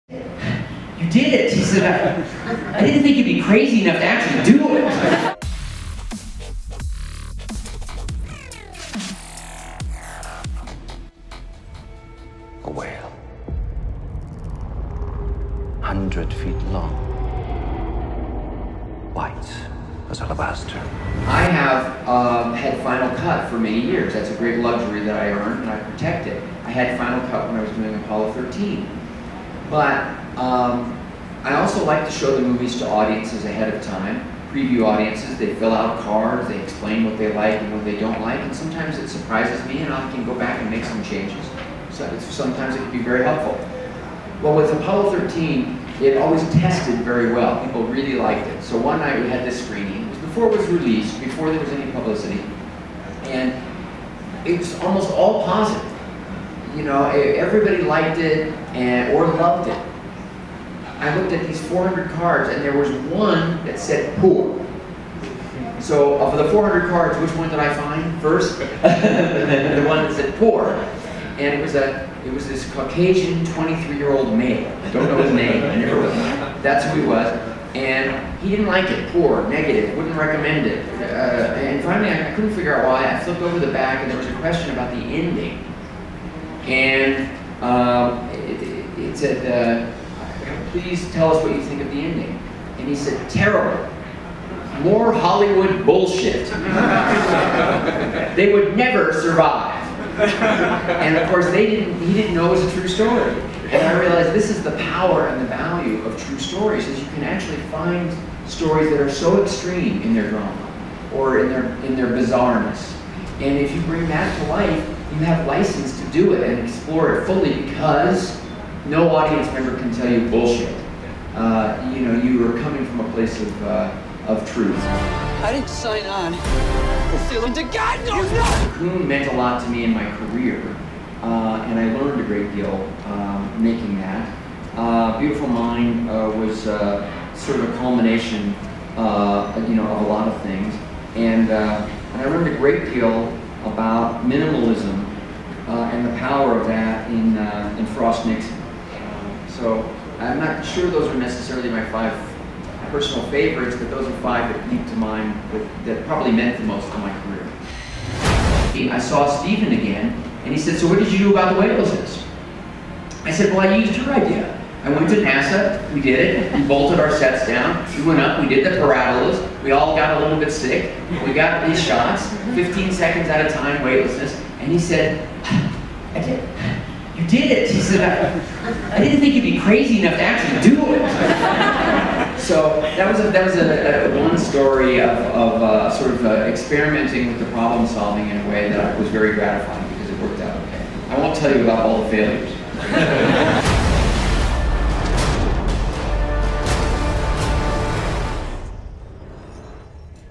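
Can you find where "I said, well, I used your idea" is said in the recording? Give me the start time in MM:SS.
02:43.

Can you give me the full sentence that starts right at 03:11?
I won't tell you about all the failures.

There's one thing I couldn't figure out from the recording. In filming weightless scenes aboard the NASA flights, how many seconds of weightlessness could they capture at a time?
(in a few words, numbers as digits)
15 seconds.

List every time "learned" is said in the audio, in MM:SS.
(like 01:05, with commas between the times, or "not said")
02:12, 02:22.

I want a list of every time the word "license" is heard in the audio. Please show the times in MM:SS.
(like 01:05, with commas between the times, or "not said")
01:55.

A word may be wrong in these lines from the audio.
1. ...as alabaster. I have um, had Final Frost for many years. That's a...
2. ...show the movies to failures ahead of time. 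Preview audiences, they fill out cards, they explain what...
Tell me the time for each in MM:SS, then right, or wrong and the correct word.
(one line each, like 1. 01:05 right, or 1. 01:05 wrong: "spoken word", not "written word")
1. 00:20 wrong: "Cut", not "Frost"
2. 00:32 wrong: "audiences", not "failures".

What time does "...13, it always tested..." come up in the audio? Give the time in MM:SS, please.
00:45.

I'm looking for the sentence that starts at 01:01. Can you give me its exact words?
I looked at these 400 cards, and there was one that said poor.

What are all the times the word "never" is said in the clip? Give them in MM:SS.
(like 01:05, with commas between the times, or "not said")
01:15, 01:38.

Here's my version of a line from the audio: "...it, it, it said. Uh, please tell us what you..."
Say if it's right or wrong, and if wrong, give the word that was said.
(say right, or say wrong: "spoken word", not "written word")
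right.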